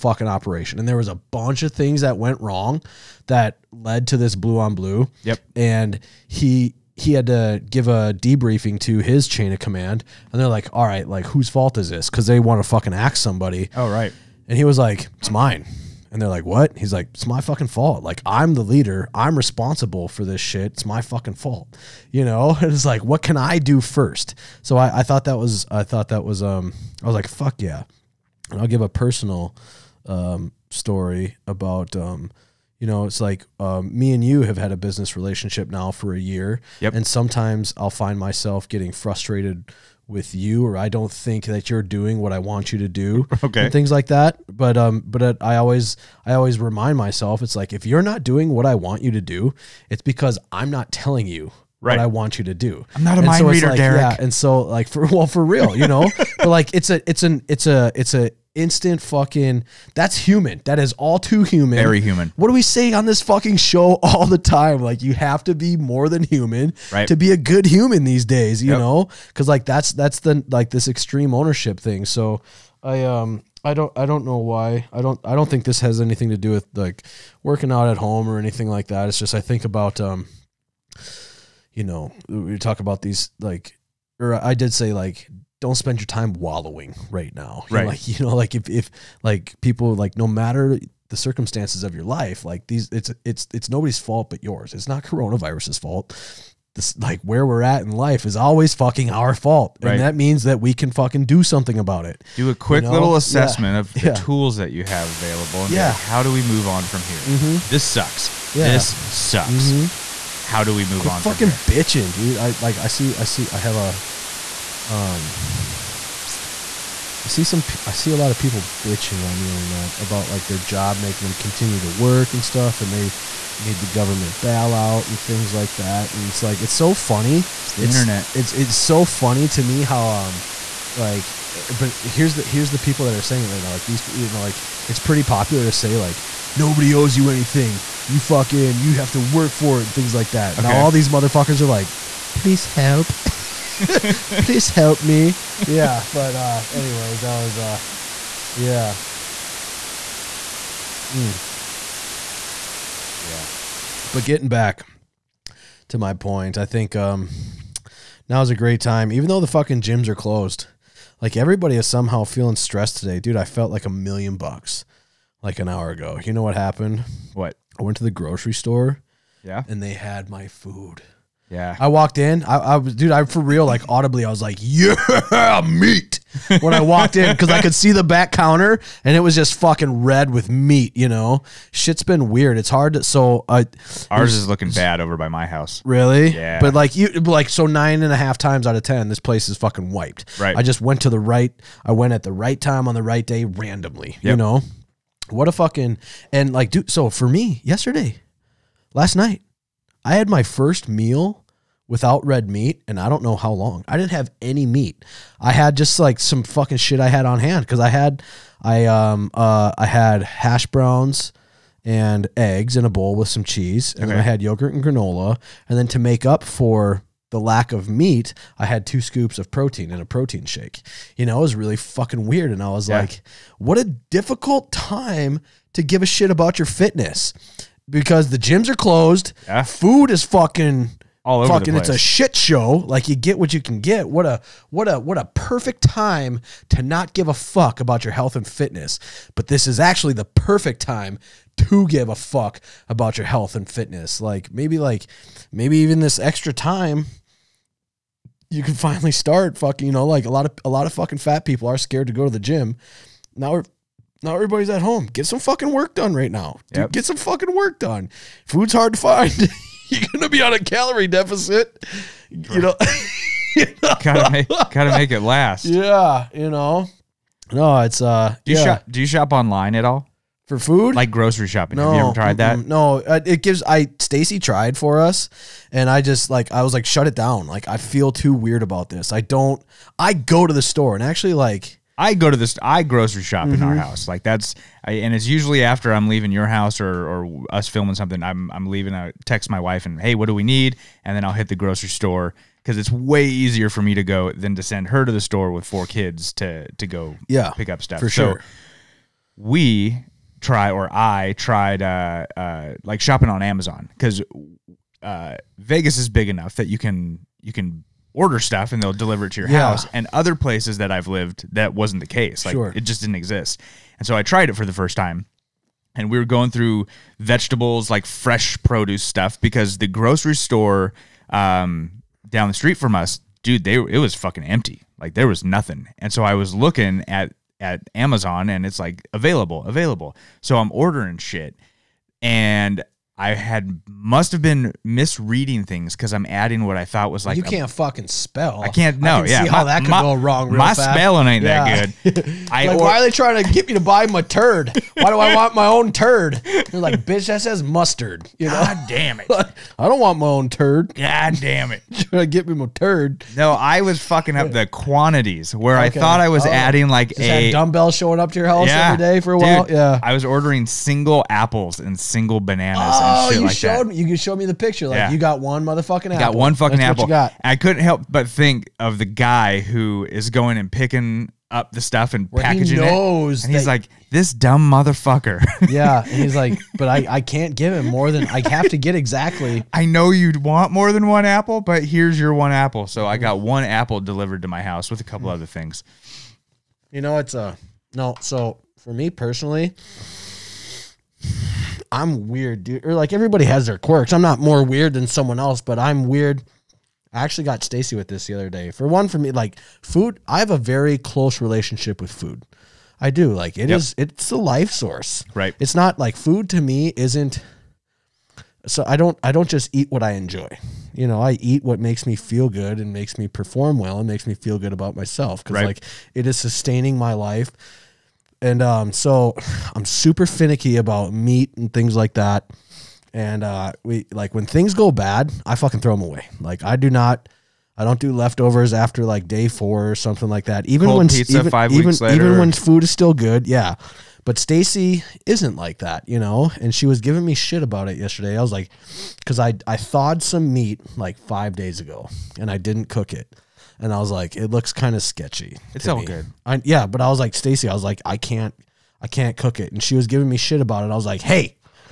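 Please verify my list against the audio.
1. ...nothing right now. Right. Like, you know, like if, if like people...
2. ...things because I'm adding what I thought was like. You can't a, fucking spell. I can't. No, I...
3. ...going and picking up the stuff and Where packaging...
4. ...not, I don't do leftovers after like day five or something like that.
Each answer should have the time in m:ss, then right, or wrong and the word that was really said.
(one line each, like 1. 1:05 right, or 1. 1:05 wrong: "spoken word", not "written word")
1. 1:26 wrong: "wallowing", not "nothing"
2. 5:35 right
3. 6:10 right
4. 7:06 wrong: "four", not "five".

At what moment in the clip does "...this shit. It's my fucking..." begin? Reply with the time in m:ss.
0:20.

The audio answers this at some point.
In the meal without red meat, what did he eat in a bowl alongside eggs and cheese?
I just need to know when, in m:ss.
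3:30.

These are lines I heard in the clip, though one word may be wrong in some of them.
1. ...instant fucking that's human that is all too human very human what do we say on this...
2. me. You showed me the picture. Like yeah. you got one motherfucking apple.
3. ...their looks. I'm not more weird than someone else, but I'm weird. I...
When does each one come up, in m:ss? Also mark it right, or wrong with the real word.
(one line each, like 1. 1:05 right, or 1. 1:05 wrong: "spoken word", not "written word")
1. 0:58 right
2. 6:03 right
3. 6:33 wrong: "quirks", not "looks".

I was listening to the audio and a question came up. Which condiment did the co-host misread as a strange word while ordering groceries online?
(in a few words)
mustard.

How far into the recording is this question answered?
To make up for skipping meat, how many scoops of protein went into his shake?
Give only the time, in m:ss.
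3:38.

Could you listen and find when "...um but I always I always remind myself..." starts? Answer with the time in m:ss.
0:44.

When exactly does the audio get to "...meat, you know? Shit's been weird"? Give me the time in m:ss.
3:00.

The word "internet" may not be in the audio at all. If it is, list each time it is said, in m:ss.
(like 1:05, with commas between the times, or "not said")
1:59, 2:07.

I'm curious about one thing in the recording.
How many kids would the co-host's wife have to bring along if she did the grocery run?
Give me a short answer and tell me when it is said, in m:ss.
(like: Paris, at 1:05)
4, at 4:55.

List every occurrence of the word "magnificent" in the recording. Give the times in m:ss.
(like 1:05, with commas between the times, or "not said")
not said.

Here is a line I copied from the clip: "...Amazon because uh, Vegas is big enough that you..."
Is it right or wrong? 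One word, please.
right.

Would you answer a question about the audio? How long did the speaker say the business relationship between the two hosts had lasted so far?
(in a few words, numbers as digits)
a year.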